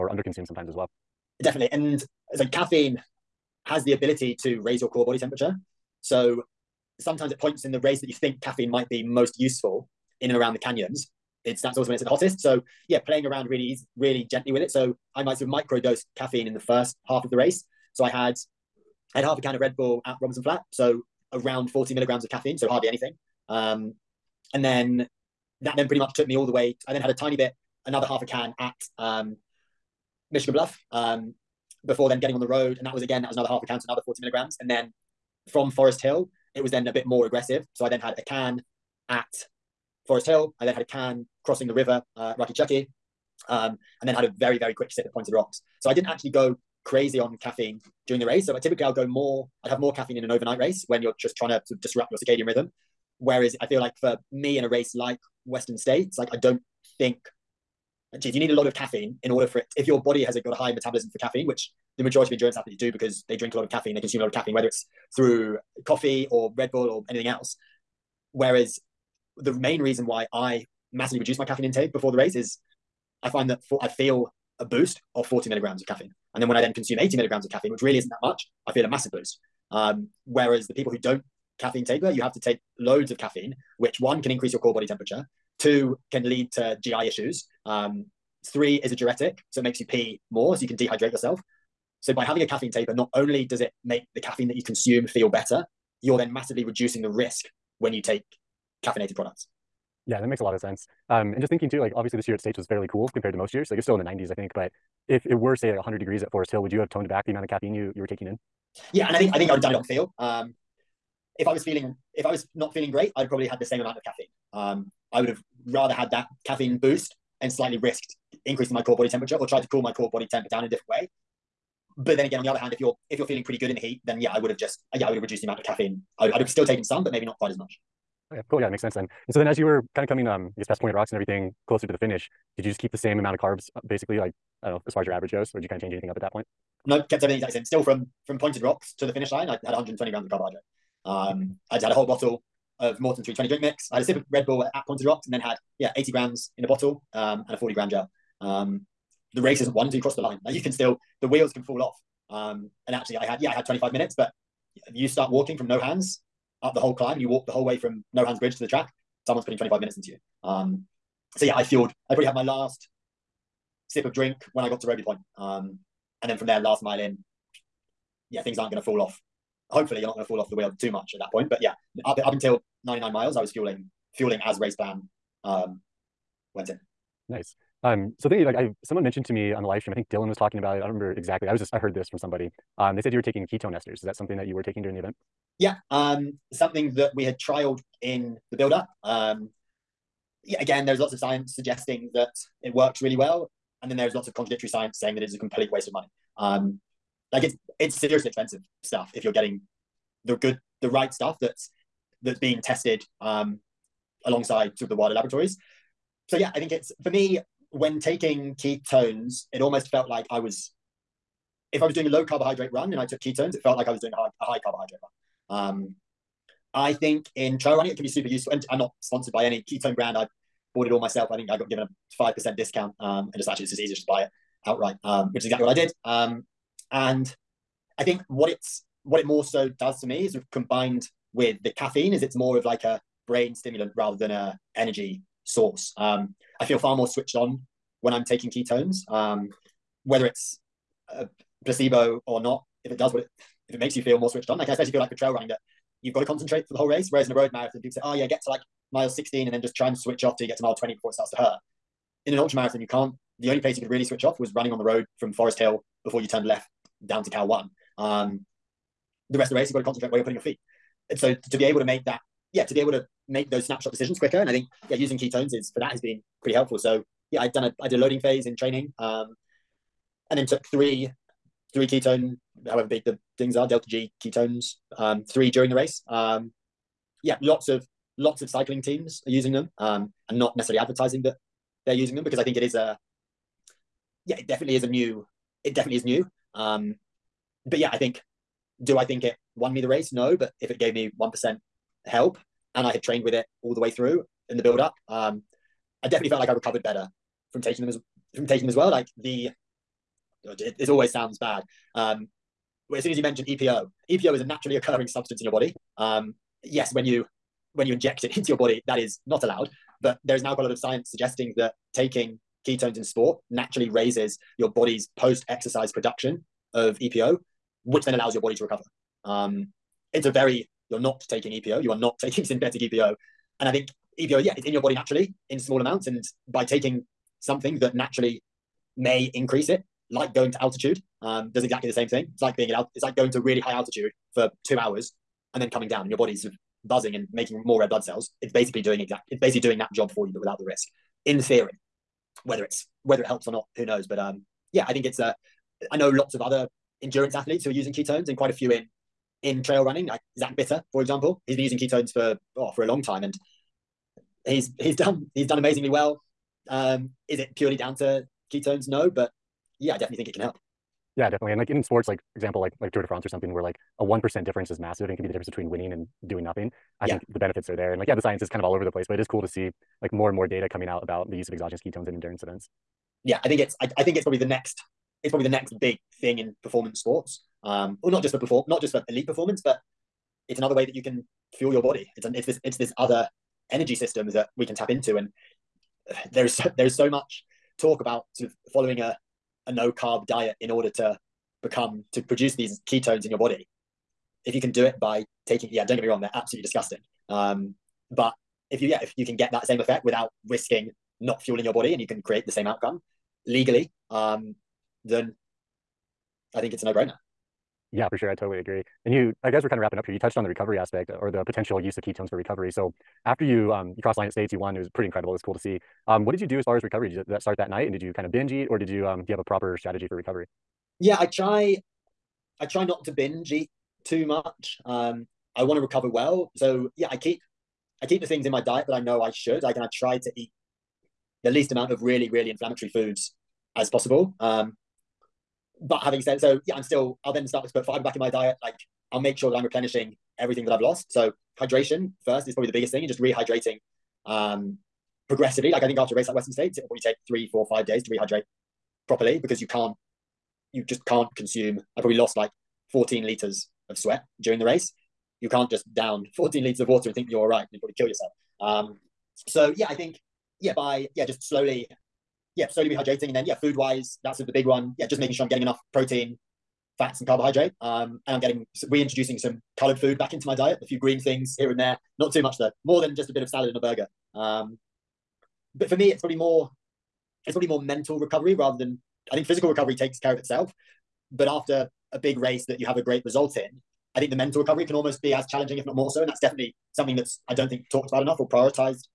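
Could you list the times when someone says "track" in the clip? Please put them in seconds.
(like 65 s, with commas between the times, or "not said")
158 s.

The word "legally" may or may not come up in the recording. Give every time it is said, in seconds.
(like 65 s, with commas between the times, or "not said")
403 s.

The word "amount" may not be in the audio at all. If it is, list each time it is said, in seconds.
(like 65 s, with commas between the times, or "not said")
107 s, 113 s, 125 s, 133 s, 325 s, 431 s.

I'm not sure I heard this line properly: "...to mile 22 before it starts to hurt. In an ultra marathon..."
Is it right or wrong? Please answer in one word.
wrong.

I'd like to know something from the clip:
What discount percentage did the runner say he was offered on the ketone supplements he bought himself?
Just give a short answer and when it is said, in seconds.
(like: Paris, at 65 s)
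5%, at 222 s.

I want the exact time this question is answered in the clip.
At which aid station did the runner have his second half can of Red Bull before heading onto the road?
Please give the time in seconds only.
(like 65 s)
30 s.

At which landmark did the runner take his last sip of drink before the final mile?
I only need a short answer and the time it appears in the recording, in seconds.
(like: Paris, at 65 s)
Robie Point, at 164 s.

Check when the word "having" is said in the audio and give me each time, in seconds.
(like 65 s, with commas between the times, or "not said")
92 s, 436 s.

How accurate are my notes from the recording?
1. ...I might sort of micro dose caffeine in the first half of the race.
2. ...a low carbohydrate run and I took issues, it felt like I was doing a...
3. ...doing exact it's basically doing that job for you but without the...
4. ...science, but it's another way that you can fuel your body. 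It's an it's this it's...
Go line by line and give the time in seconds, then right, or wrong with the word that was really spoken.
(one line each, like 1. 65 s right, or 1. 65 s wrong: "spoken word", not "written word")
1. 15 s right
2. 212 s wrong: "ketones", not "issues"
3. 338 s right
4. 379 s wrong: "performance", not "science".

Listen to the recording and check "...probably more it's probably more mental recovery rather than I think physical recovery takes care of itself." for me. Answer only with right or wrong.
right.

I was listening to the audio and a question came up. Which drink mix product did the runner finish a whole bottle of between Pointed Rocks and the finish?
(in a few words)
Maurten 320.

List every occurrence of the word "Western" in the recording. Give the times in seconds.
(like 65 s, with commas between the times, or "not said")
55 s, 446 s.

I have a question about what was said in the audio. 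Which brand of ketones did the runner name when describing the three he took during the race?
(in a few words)
Delta G.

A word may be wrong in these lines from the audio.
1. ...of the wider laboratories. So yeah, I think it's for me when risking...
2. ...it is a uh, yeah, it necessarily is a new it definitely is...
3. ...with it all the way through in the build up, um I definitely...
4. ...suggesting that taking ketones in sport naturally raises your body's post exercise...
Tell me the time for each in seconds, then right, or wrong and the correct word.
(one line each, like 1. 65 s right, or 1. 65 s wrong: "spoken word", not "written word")
1. 204 s wrong: "taking", not "risking"
2. 282 s wrong: "definitely", not "necessarily"
3. 293 s right
4. 311 s right.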